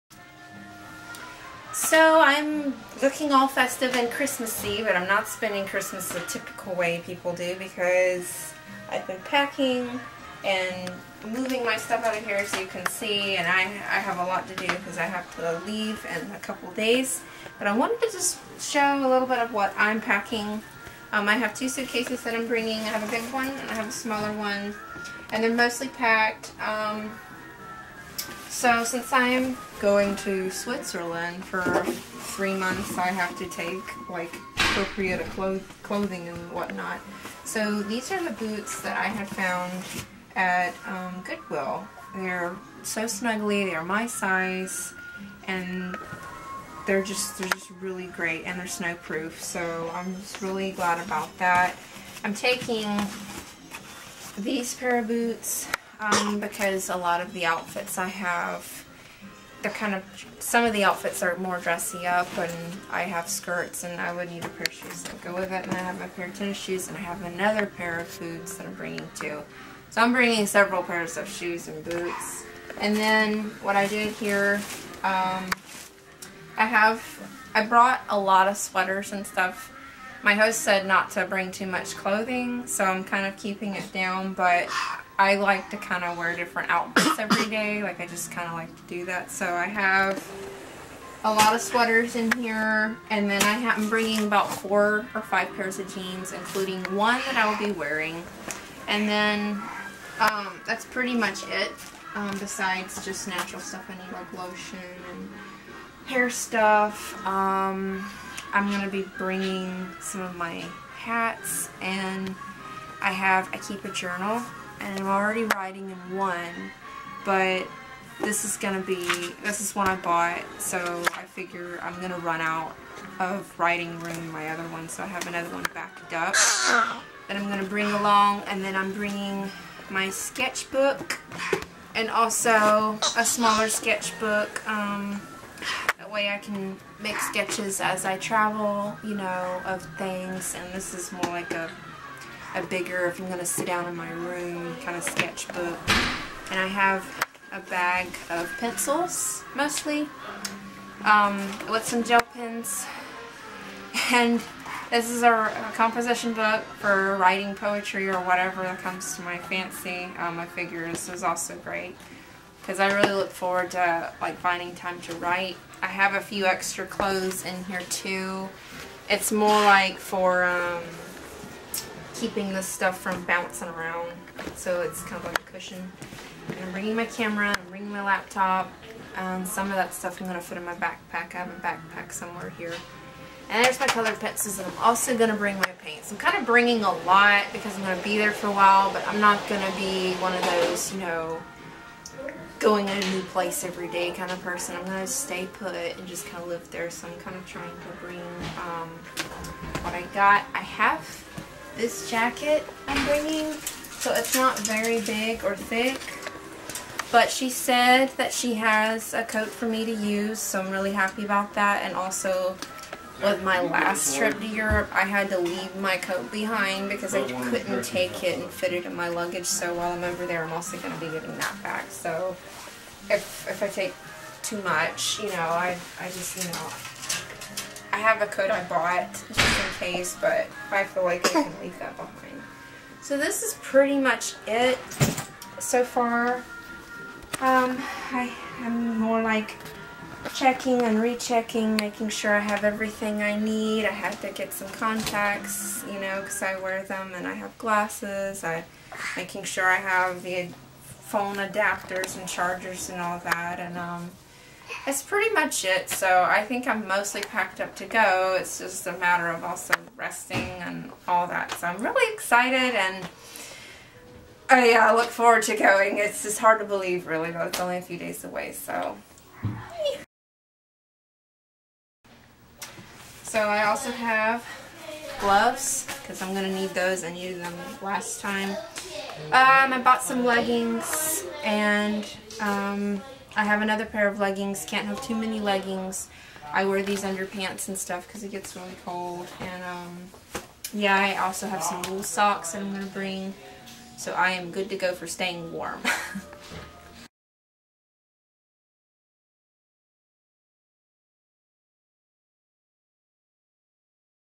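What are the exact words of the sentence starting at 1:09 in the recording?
So I'm bringing several pairs of shoes and boots.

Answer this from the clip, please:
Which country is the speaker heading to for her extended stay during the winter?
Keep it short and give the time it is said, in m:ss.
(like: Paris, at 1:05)
Switzerland, at 0:30.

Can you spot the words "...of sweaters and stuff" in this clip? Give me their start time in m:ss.
1:18.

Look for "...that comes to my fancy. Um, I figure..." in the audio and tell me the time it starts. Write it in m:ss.
2:38.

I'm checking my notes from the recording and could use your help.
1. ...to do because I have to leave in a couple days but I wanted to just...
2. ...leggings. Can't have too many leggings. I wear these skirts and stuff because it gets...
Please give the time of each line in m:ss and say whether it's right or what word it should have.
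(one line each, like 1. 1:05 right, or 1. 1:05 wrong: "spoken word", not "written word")
1. 0:14 right
2. 4:44 wrong: "underpants", not "skirts".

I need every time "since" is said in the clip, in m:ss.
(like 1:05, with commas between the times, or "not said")
0:28.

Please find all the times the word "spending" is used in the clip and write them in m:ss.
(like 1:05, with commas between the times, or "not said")
0:05.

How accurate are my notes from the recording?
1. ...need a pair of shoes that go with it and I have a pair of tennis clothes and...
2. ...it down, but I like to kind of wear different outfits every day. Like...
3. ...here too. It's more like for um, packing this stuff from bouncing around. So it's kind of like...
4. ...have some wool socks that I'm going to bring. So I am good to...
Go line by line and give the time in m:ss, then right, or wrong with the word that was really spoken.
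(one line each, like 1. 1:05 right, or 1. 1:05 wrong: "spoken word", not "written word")
1. 1:04 wrong: "shoes", not "clothes"
2. 1:23 right
3. 2:47 wrong: "keeping", not "packing"
4. 4:51 right.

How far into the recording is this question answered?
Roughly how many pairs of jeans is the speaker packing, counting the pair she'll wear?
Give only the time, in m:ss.
1:34.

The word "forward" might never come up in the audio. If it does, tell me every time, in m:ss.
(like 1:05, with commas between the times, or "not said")
2:43, 4:25.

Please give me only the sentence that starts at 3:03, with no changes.
And there's my colored pencils, and I'm also going to bring my paints.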